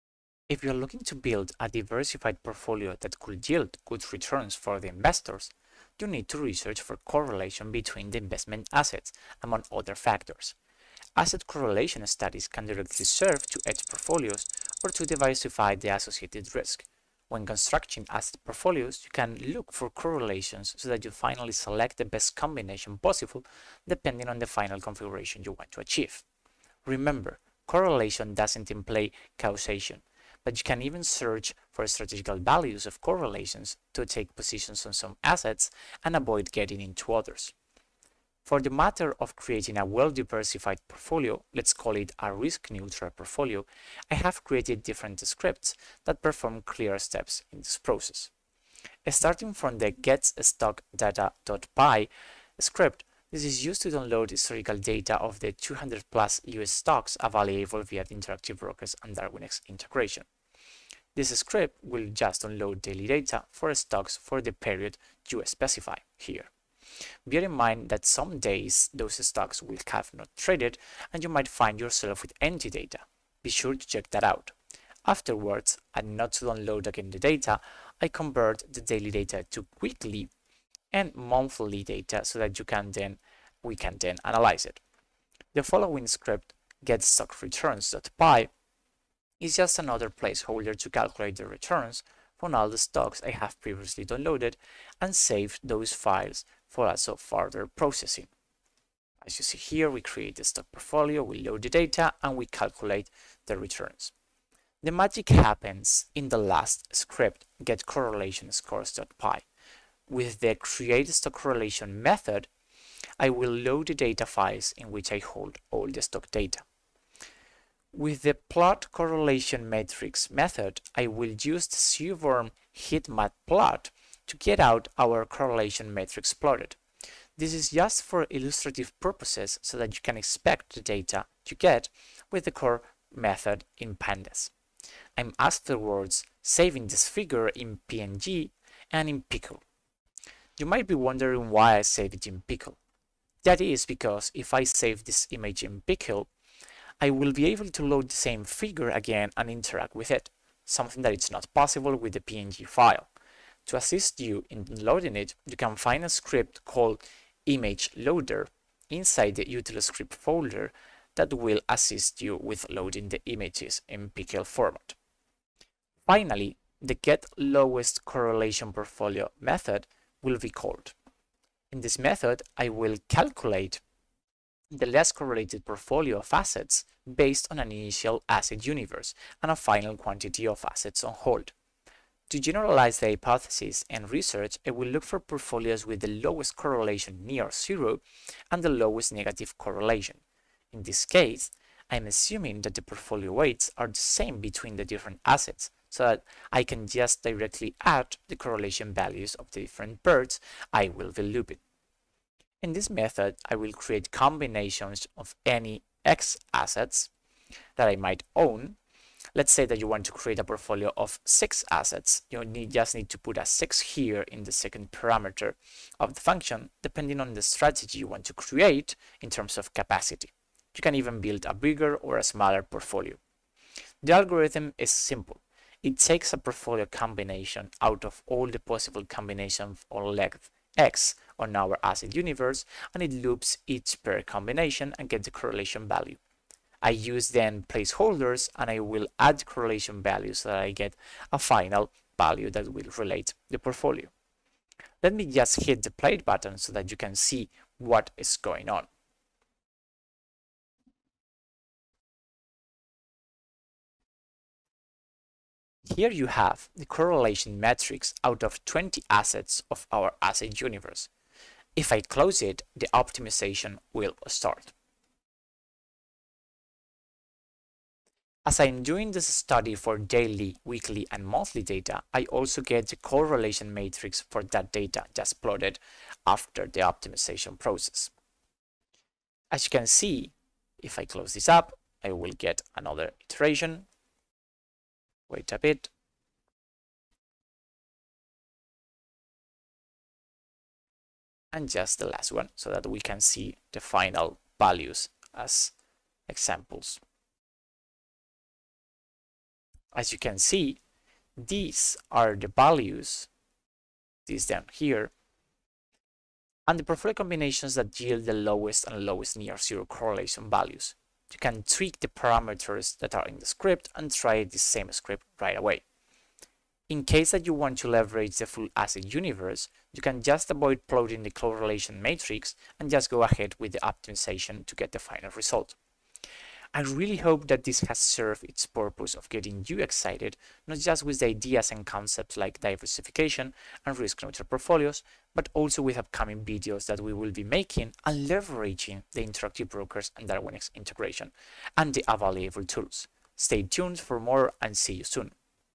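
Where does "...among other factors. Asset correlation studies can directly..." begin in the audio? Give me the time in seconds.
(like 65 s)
9 s.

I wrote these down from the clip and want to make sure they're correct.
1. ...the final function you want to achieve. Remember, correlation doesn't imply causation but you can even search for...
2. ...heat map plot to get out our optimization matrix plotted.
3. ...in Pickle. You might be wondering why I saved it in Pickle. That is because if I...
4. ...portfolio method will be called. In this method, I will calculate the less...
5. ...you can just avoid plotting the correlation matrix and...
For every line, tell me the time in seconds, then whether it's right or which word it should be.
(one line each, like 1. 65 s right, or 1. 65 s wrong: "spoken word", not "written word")
1. 24 s wrong: "configuration", not "function"
2. 122 s wrong: "correlation", not "optimization"
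3. 139 s right
4. 168 s right
5. 319 s right.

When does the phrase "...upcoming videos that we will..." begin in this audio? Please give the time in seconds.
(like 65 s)
335 s.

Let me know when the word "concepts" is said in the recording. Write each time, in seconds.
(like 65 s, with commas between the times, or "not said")
331 s.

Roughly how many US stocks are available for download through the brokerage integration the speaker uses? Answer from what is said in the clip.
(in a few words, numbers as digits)
200 plus.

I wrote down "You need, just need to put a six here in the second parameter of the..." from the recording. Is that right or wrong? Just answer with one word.
right.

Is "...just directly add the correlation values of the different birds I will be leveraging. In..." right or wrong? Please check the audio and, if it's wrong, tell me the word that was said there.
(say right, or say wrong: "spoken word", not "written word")
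wrong: "looping", not "leveraging".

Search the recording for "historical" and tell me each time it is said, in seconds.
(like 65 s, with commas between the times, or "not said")
54 s.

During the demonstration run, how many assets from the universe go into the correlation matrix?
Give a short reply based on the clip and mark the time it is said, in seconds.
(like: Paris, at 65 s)
20, at 258 s.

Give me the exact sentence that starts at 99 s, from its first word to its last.
As you see here, we create the stock portfolio, we load the data, and we calculate the returns.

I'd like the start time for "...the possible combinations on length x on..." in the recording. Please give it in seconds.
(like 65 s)
228 s.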